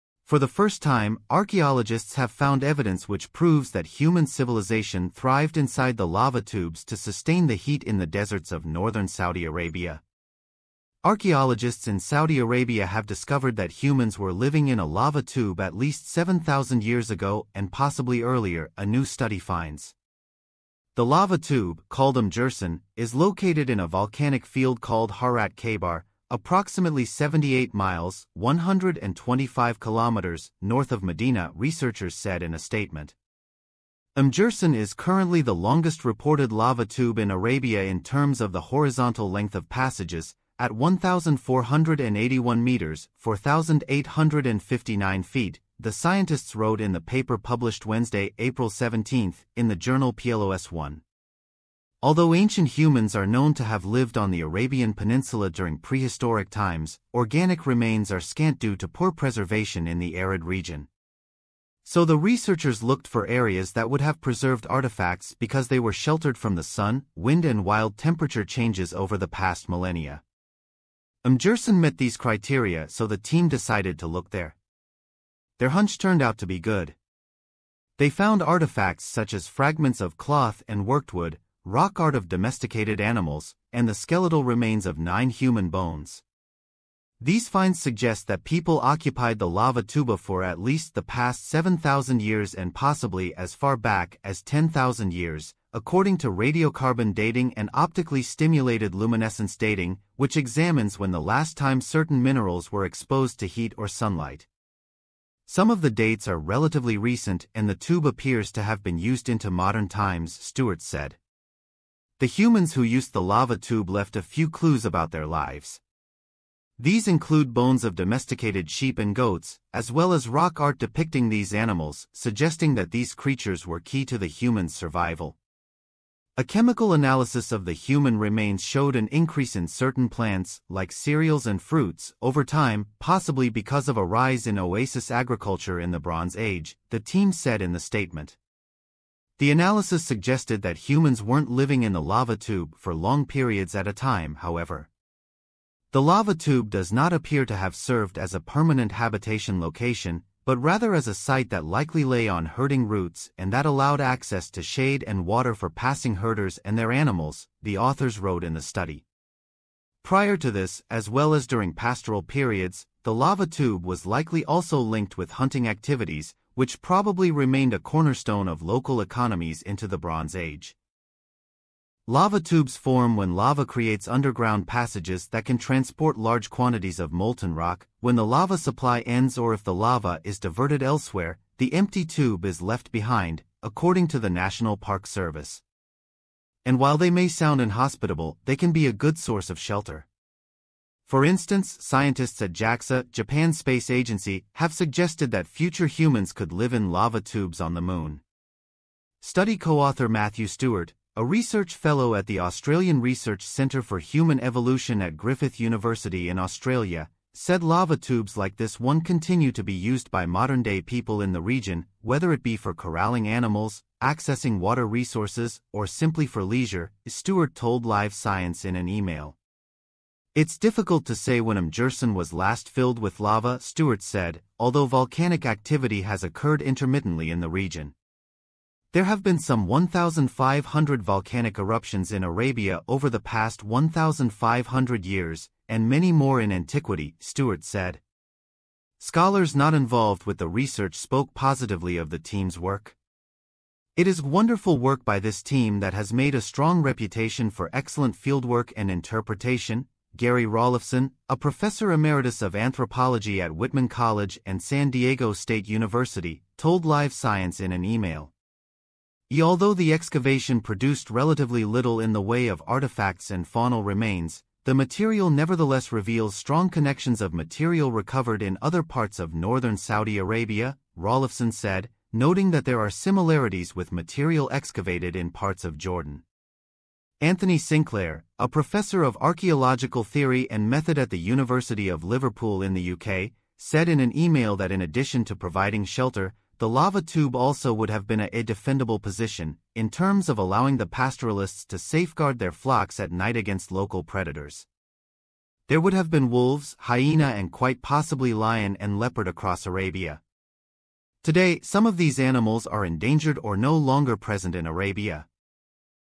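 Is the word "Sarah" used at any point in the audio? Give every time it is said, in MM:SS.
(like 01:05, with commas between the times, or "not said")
not said.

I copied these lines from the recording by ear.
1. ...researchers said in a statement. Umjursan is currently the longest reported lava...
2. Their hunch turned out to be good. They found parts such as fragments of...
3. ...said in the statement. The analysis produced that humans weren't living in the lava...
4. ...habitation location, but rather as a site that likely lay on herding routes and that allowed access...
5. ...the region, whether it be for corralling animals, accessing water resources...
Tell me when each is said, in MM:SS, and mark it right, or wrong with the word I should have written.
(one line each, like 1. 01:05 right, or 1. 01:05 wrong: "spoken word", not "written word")
1. 00:31 right
2. 01:15 wrong: "artifacts", not "parts"
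3. 02:17 wrong: "suggested", not "produced"
4. 02:28 right
5. 03:31 right.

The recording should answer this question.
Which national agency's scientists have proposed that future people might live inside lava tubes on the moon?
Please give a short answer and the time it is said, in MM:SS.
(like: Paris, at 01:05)
JAXA, at 03:12.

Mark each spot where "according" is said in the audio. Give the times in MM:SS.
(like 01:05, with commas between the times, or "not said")
01:35, 03:03.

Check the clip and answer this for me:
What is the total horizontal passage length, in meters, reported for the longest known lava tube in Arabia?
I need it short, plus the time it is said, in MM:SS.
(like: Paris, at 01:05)
1,481 meters, at 00:40.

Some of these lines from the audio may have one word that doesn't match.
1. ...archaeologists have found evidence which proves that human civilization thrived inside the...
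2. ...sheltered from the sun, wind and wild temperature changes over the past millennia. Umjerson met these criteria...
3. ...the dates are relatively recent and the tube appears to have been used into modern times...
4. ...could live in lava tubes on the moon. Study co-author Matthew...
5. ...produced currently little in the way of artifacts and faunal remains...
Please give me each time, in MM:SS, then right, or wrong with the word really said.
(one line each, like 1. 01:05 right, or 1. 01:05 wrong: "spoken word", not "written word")
1. 00:01 right
2. 01:05 right
3. 01:45 right
4. 03:16 right
5. 04:20 wrong: "relatively", not "currently".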